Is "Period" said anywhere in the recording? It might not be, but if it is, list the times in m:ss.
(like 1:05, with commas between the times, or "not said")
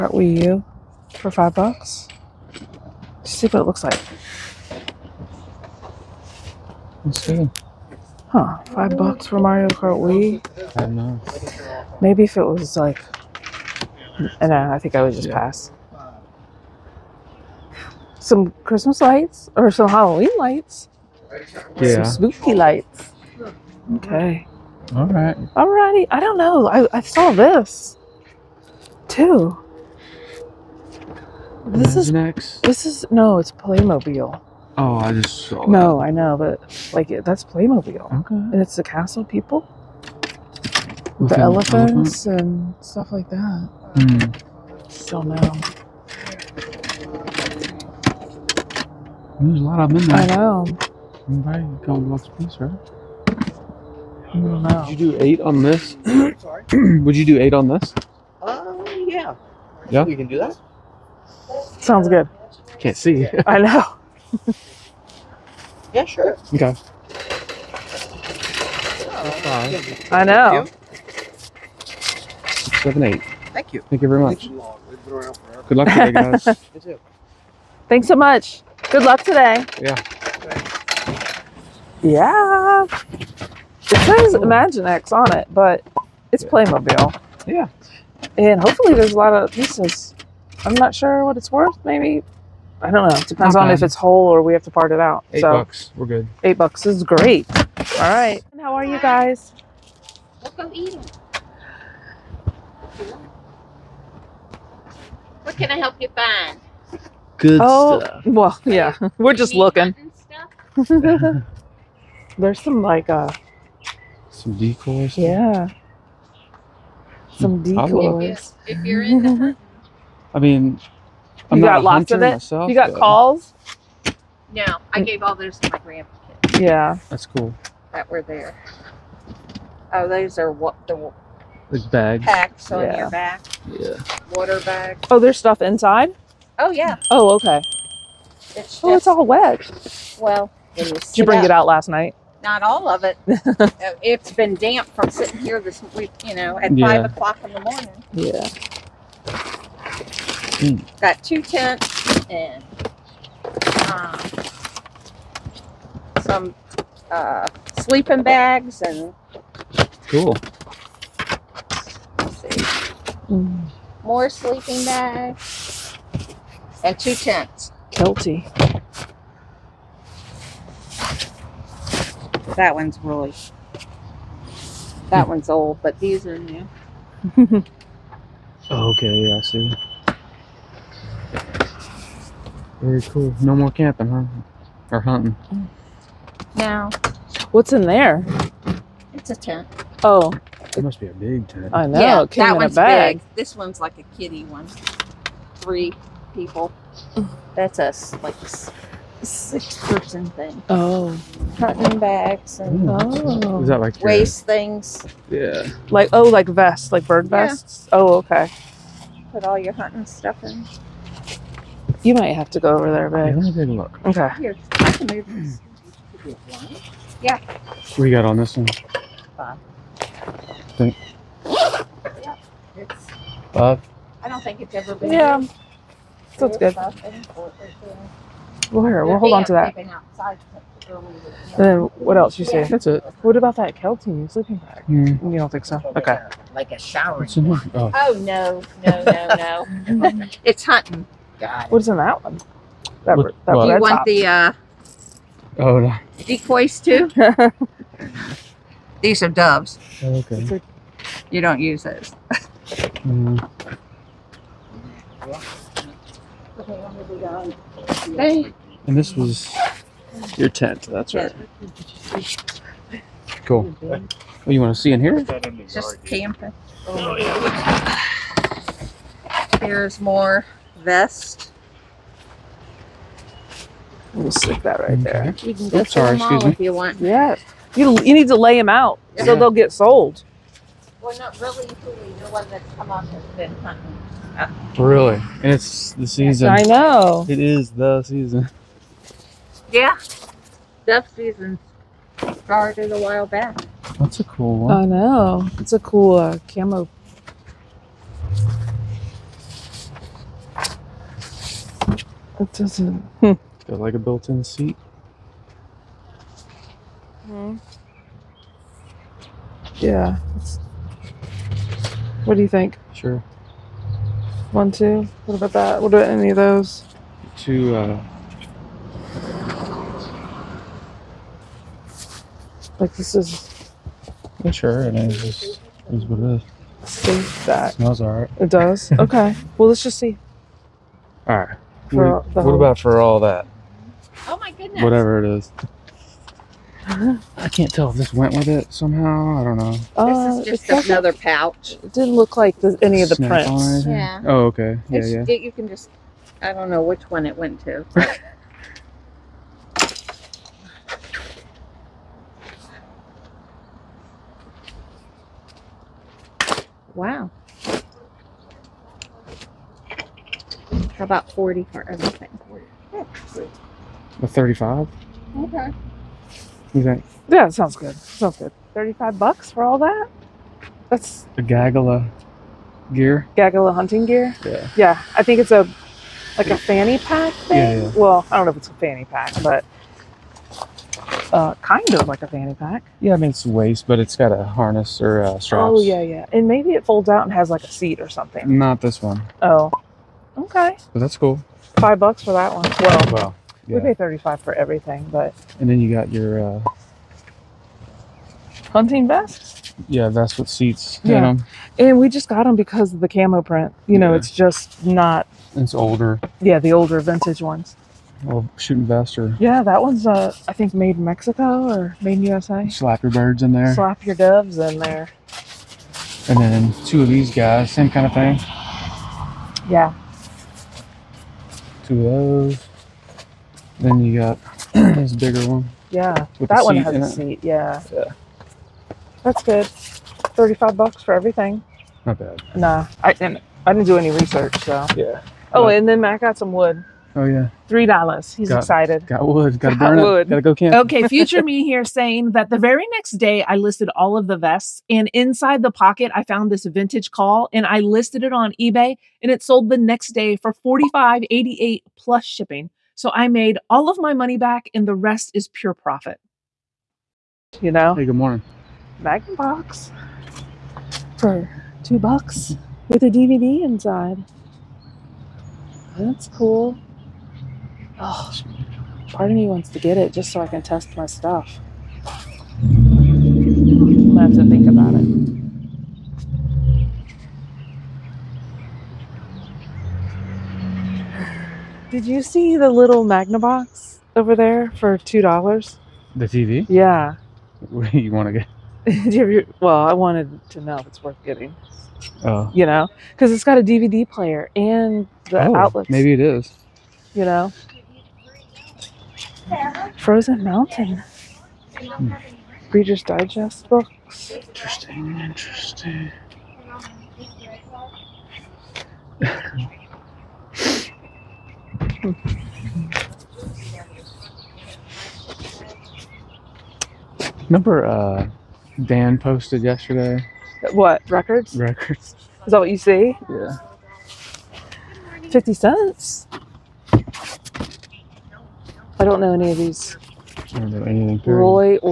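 8:51.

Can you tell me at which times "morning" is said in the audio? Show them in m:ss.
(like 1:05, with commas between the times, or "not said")
2:27, 7:38.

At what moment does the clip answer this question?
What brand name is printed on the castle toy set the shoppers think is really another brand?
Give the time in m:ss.
1:24.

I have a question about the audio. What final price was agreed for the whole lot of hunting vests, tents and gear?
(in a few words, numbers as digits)
$35.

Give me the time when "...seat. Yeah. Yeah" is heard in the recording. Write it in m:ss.
7:07.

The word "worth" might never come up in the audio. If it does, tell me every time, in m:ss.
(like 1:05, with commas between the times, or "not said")
1:31, 8:11.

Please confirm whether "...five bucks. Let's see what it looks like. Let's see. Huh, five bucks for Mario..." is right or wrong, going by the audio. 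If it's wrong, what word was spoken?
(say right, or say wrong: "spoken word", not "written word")
right.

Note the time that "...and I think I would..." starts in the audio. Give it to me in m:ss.
0:14.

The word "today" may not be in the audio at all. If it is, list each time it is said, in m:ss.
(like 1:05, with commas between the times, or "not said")
1:19.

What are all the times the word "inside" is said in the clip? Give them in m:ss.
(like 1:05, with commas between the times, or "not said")
2:15, 7:25, 7:43.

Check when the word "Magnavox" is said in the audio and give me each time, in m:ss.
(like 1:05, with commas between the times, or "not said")
7:39, 8:03.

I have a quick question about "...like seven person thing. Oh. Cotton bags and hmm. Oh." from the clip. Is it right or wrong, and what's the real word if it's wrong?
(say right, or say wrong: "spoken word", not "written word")
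wrong: "six", not "seven".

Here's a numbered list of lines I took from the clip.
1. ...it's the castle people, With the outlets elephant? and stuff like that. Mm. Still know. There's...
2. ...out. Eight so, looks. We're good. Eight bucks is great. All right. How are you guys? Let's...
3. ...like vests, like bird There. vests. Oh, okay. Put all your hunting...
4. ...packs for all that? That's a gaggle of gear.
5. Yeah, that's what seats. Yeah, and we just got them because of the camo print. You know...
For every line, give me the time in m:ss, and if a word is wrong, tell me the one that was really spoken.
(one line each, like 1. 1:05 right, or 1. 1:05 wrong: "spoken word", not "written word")
1. 0:38 wrong: "elephants", not "outlets"
2. 1:34 wrong: "bucks", not "looks"
3. 3:26 wrong: "Yeah", not "There"
4. 6:09 wrong: "bucks", not "packs"
5. 6:39 right.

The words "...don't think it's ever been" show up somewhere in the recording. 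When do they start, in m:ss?
3:44.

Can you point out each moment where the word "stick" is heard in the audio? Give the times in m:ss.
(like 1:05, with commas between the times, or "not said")
4:34.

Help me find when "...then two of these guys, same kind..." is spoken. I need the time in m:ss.
6:56.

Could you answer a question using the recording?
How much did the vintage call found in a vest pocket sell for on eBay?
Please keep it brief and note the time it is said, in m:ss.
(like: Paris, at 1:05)
$45.88, at 7:30.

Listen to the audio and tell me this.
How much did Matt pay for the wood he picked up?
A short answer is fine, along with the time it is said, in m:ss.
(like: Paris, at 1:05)
$3, at 7:17.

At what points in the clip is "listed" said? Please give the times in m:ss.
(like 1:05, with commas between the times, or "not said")
7:23, 7:27.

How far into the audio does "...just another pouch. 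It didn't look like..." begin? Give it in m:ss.
5:40.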